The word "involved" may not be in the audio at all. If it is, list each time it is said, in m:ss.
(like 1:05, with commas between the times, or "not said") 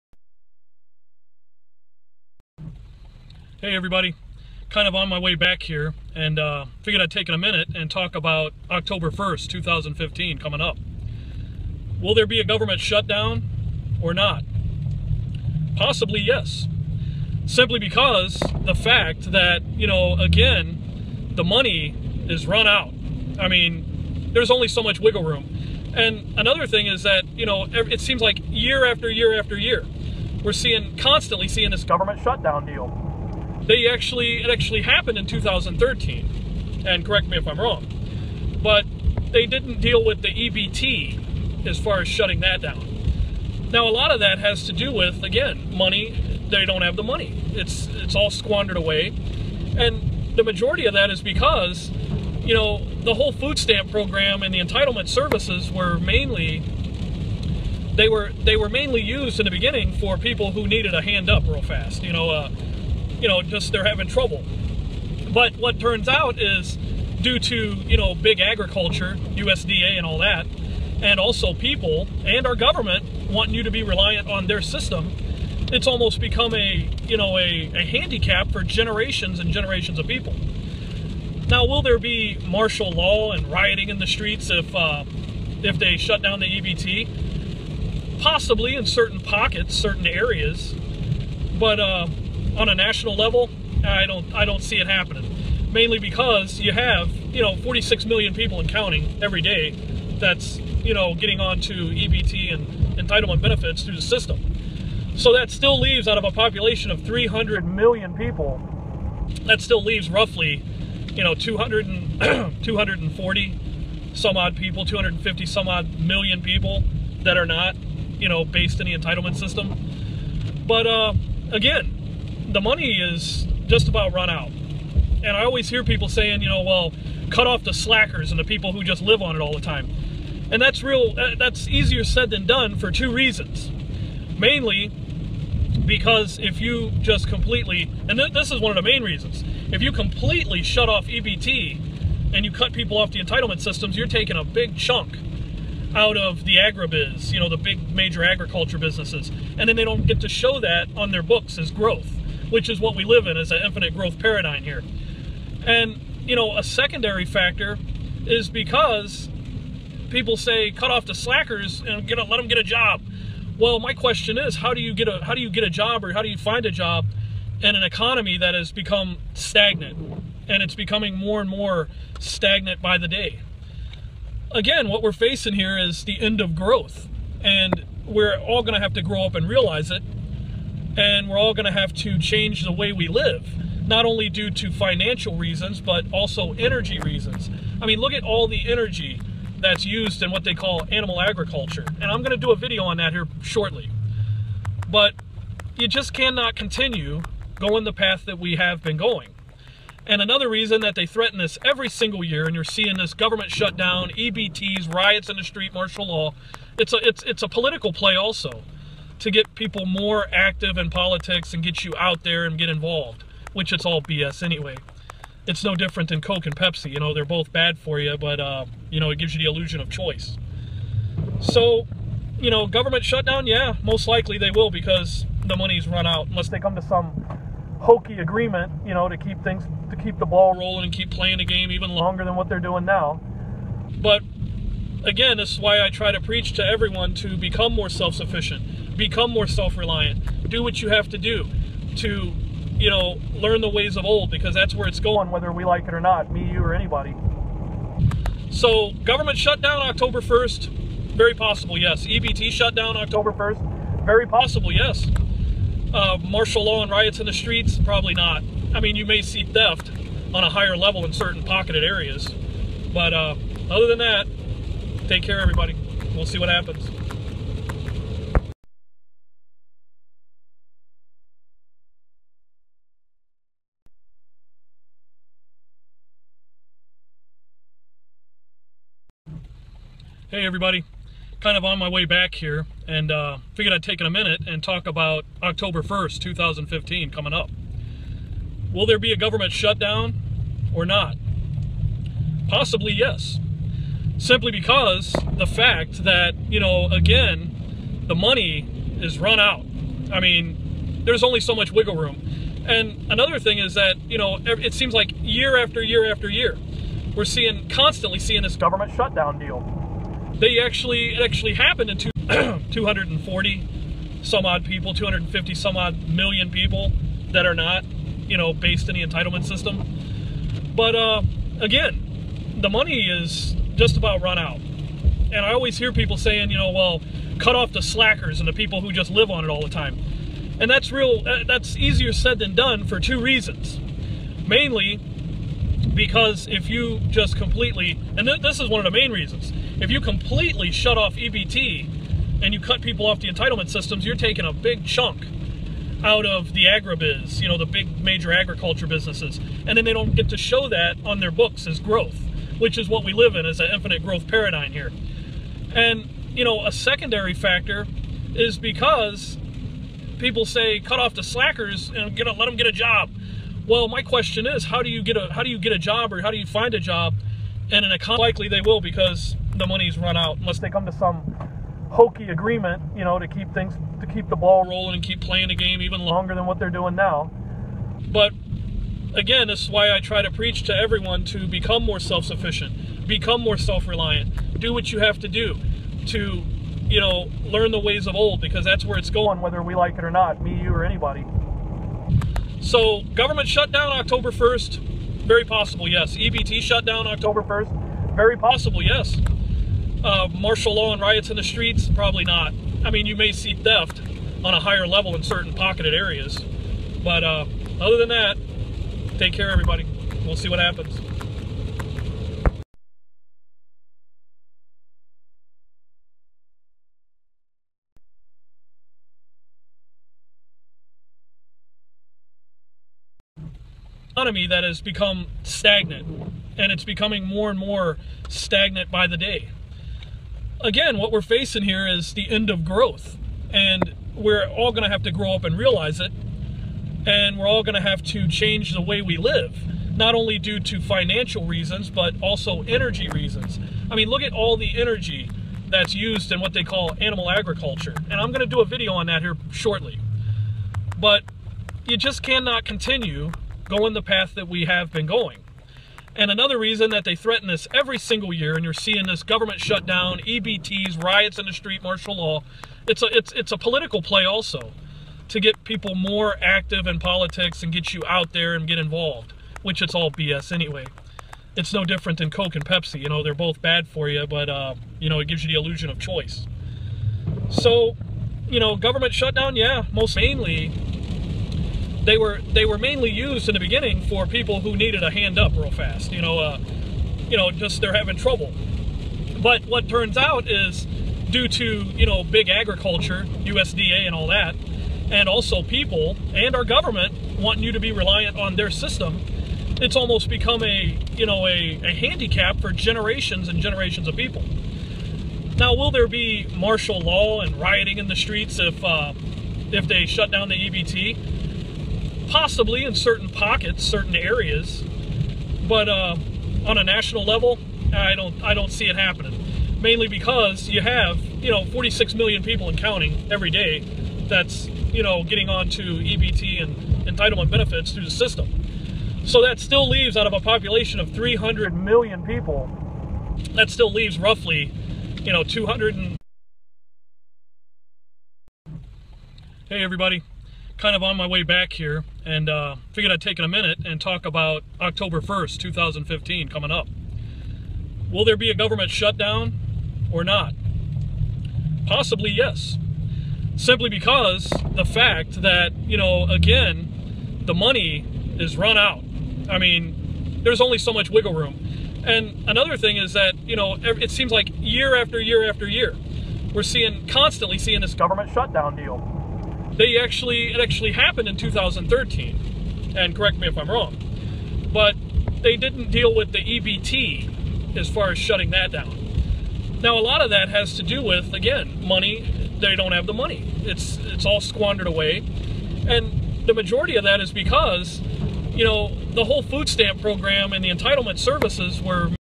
3:32, 7:48.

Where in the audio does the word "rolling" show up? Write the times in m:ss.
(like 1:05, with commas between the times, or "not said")
3:50, 6:14.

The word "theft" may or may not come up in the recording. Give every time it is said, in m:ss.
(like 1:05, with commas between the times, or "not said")
4:19, 6:43.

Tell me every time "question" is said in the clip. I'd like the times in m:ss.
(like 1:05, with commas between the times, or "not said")
2:43, 6:04.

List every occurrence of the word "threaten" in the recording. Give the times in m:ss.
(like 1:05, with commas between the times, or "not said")
3:21, 7:37.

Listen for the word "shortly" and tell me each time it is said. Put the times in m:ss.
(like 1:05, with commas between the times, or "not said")
3:13, 7:29.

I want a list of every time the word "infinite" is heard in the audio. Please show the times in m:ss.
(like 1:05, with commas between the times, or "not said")
2:33, 5:53.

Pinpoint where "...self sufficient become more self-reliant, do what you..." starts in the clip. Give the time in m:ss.
3:57.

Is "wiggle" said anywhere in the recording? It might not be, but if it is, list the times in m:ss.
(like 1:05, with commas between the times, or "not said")
0:24, 5:01, 9:21.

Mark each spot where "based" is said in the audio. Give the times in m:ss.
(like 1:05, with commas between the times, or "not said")
1:58, 5:18.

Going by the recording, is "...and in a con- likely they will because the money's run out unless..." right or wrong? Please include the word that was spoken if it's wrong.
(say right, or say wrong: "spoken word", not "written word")
right.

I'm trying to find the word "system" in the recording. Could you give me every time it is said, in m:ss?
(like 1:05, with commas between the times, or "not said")
1:14, 1:44, 1:59, 2:23, 5:19, 5:43, 8:18, 8:48.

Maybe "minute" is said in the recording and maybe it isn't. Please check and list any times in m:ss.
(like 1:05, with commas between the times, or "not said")
0:07, 4:44, 9:03.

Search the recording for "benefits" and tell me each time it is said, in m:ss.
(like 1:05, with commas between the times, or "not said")
1:43, 8:47.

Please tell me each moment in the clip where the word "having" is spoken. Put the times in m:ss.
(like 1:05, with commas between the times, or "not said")
1:03, 8:07.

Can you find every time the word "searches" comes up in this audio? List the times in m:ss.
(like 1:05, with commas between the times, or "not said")
not said.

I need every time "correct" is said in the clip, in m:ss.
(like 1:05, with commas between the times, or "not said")
0:37, 9:33.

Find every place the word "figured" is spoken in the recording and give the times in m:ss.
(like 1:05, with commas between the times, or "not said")
0:06, 4:43, 9:02.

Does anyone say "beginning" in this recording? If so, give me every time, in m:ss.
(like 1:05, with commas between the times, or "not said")
0:59, 8:03.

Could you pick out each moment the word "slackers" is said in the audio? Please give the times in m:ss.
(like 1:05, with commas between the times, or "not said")
2:07, 2:41, 5:27, 6:01.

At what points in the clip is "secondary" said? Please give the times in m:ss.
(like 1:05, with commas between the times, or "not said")
2:36, 5:56.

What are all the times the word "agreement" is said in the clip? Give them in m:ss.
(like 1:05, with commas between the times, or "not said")
3:48, 6:12.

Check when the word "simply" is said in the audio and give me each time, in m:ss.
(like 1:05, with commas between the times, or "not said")
0:17, 4:54, 9:13.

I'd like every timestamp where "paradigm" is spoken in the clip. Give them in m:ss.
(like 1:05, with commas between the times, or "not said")
2:34, 5:54.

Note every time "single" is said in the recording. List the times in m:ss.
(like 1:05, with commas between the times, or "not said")
3:21, 7:37.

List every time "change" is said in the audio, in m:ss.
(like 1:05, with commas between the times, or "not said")
3:02, 7:18.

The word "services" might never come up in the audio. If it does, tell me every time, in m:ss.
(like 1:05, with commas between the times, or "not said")
0:55, 9:51.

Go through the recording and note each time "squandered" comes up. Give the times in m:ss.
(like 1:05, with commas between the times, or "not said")
0:48, 9:44.